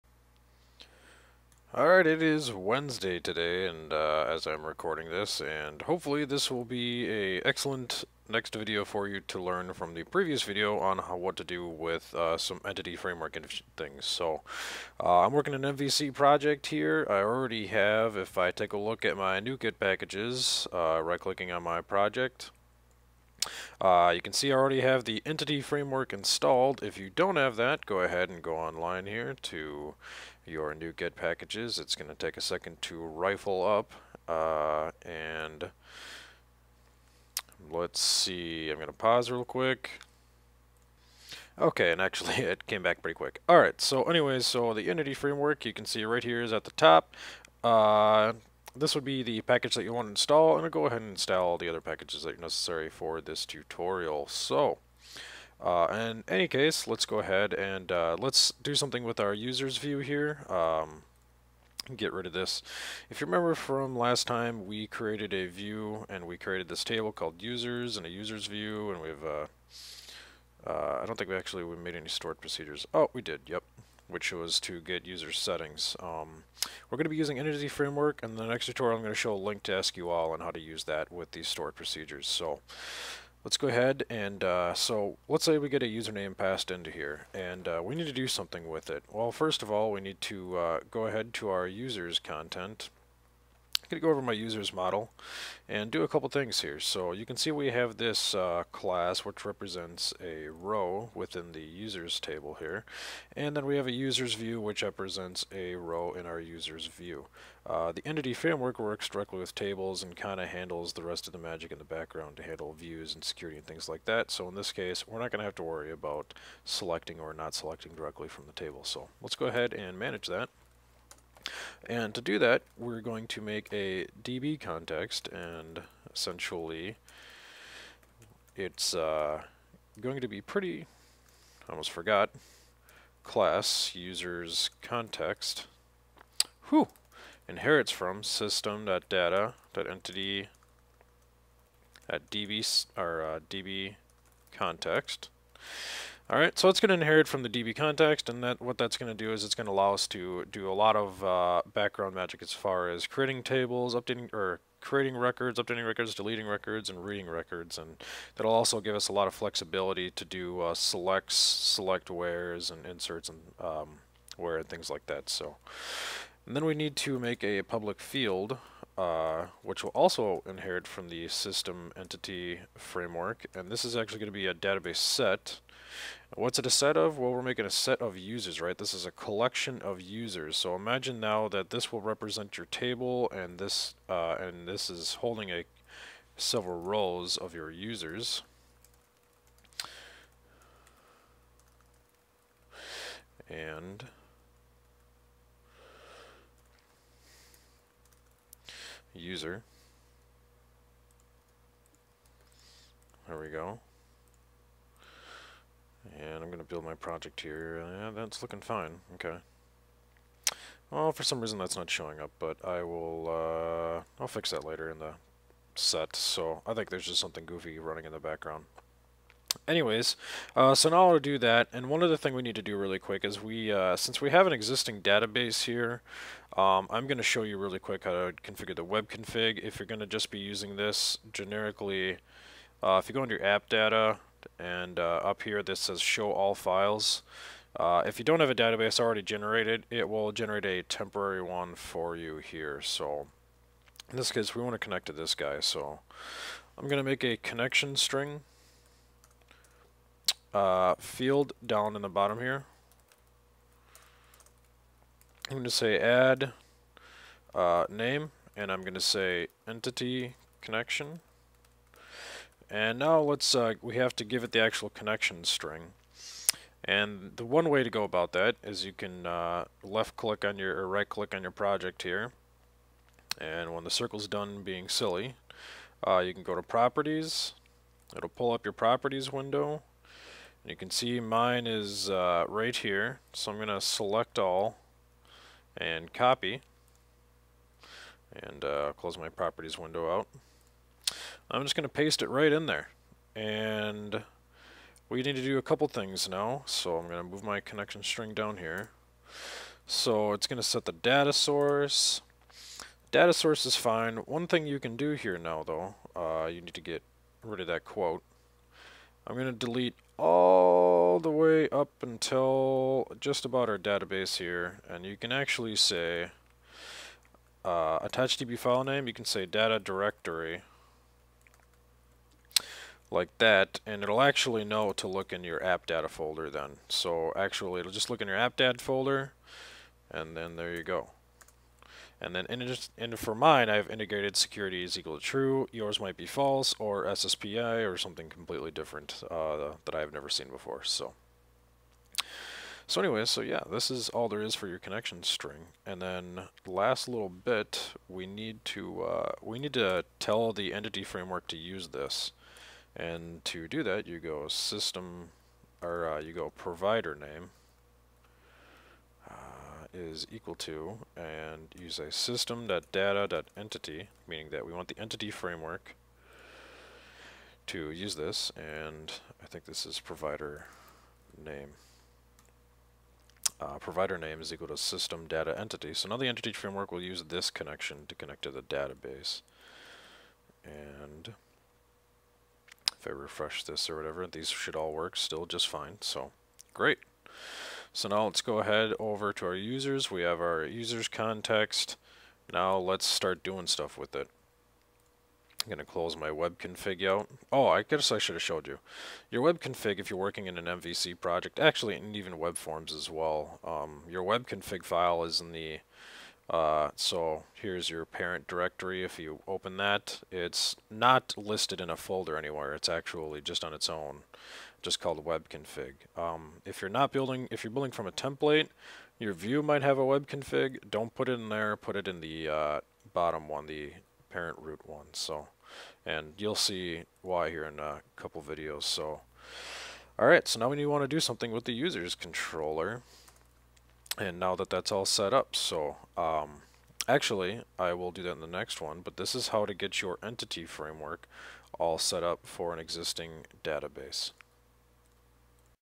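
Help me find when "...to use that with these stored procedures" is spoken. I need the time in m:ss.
1:20.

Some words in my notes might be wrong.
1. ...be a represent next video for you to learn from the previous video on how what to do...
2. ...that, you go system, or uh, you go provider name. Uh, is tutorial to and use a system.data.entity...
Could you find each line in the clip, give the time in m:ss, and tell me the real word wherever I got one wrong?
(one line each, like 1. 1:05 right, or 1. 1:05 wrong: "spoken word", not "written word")
1. 0:06 wrong: "excellent", not "represent"
2. 5:53 wrong: "equal", not "tutorial".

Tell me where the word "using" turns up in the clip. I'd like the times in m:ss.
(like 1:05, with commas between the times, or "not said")
1:17, 3:50.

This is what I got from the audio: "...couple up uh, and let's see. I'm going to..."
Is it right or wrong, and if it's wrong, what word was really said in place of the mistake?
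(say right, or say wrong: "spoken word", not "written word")
wrong: "rifle", not "couple".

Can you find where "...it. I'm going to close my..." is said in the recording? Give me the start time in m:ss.
6:34.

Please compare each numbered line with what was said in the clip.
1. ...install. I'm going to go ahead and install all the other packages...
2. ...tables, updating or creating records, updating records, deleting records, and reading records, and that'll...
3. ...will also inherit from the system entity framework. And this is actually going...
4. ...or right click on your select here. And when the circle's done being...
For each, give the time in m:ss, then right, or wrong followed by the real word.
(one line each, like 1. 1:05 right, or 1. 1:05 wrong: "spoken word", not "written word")
1. 0:50 right
2. 2:33 right
3. 2:49 right
4. 4:30 wrong: "project", not "select".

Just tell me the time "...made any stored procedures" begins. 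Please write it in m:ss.
1:11.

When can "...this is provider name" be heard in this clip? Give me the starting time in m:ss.
6:09.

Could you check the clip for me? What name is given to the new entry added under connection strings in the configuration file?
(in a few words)
entity connection.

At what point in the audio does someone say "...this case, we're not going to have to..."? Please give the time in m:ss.
1:54.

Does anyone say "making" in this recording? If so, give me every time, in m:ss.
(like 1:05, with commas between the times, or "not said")
2:57.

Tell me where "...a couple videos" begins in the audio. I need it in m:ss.
7:07.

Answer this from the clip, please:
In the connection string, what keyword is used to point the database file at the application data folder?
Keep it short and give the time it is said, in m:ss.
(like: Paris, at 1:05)
attach DB file name, at 5:18.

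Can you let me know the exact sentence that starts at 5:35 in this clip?
Yours might be false or SSPI or something completely different uh, that I've never seen before.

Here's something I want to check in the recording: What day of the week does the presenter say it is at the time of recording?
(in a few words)
Wednesday.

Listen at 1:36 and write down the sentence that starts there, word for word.
So you can see we have this uh, class which represents a row within the users table here.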